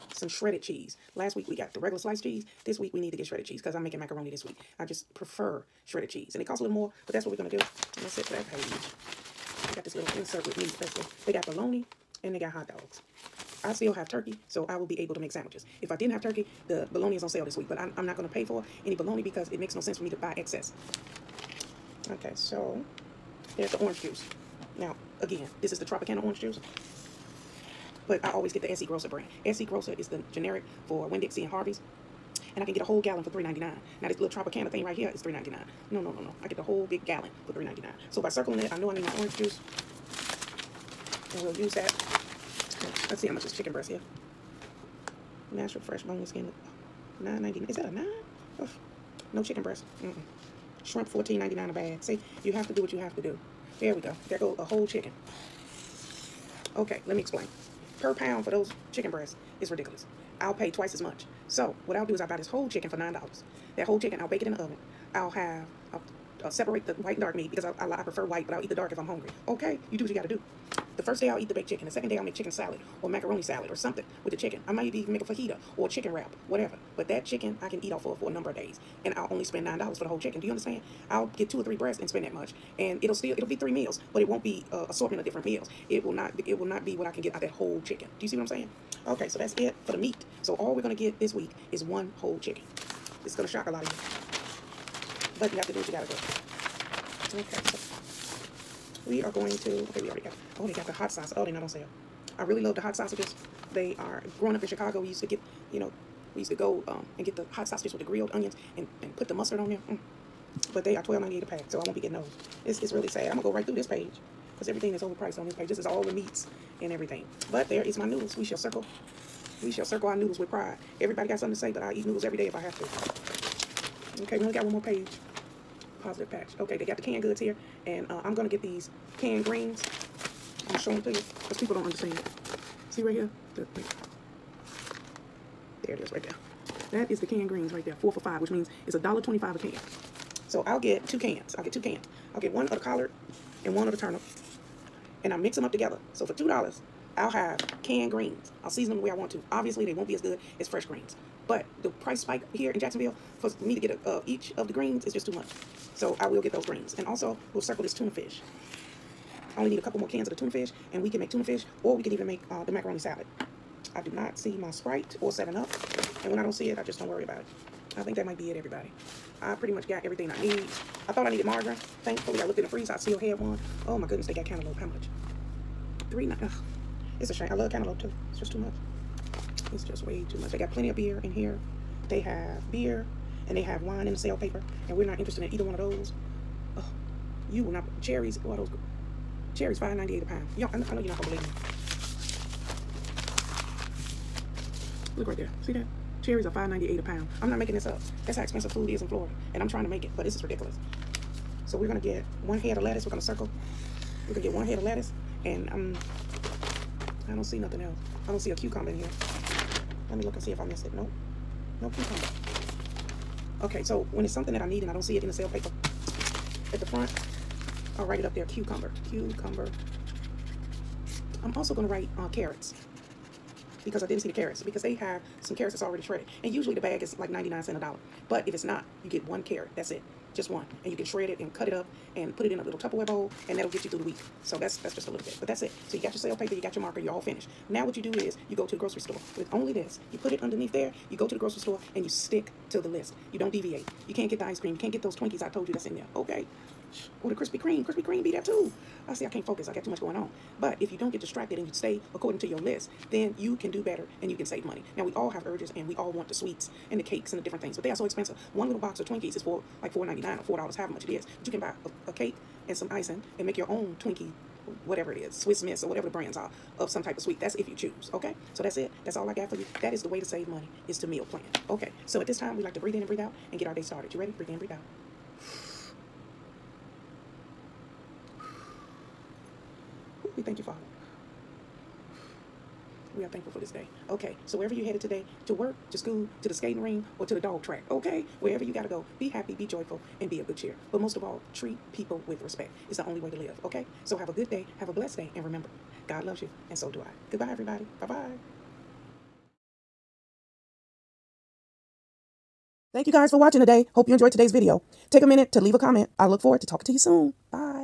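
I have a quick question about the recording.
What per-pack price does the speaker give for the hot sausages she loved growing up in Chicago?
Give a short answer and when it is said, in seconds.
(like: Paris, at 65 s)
$12.98, at 111 s.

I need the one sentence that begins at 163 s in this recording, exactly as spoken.
I do not see my Sprite or 7-Up.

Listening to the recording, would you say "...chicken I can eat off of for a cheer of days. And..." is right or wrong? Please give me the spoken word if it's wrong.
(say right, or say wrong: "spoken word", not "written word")
wrong: "number", not "cheer".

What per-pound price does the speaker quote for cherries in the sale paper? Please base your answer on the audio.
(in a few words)
$5.98.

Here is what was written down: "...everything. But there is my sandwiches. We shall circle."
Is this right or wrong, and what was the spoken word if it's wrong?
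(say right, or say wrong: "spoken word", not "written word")
wrong: "noodles", not "sandwiches".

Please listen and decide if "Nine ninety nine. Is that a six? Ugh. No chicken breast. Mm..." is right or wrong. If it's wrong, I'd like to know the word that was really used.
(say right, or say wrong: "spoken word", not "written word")
wrong: "nine", not "six".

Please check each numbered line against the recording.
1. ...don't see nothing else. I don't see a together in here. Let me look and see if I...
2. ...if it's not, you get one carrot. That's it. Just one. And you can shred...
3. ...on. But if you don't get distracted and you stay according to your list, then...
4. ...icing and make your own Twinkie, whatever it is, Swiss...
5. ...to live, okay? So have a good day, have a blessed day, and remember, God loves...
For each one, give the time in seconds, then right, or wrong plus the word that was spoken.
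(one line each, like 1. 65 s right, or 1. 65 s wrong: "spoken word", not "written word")
1. 207 s wrong: "cucumber", not "together"
2. 228 s right
3. 250 s right
4. 262 s right
5. 293 s right.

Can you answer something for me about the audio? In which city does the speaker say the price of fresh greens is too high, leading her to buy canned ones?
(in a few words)
Jacksonville.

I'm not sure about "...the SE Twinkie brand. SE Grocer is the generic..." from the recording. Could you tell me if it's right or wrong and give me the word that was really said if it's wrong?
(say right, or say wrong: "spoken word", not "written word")
wrong: "Grocer", not "Twinkie".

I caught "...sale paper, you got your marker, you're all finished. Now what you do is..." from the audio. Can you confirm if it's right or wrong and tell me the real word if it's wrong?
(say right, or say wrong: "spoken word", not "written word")
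right.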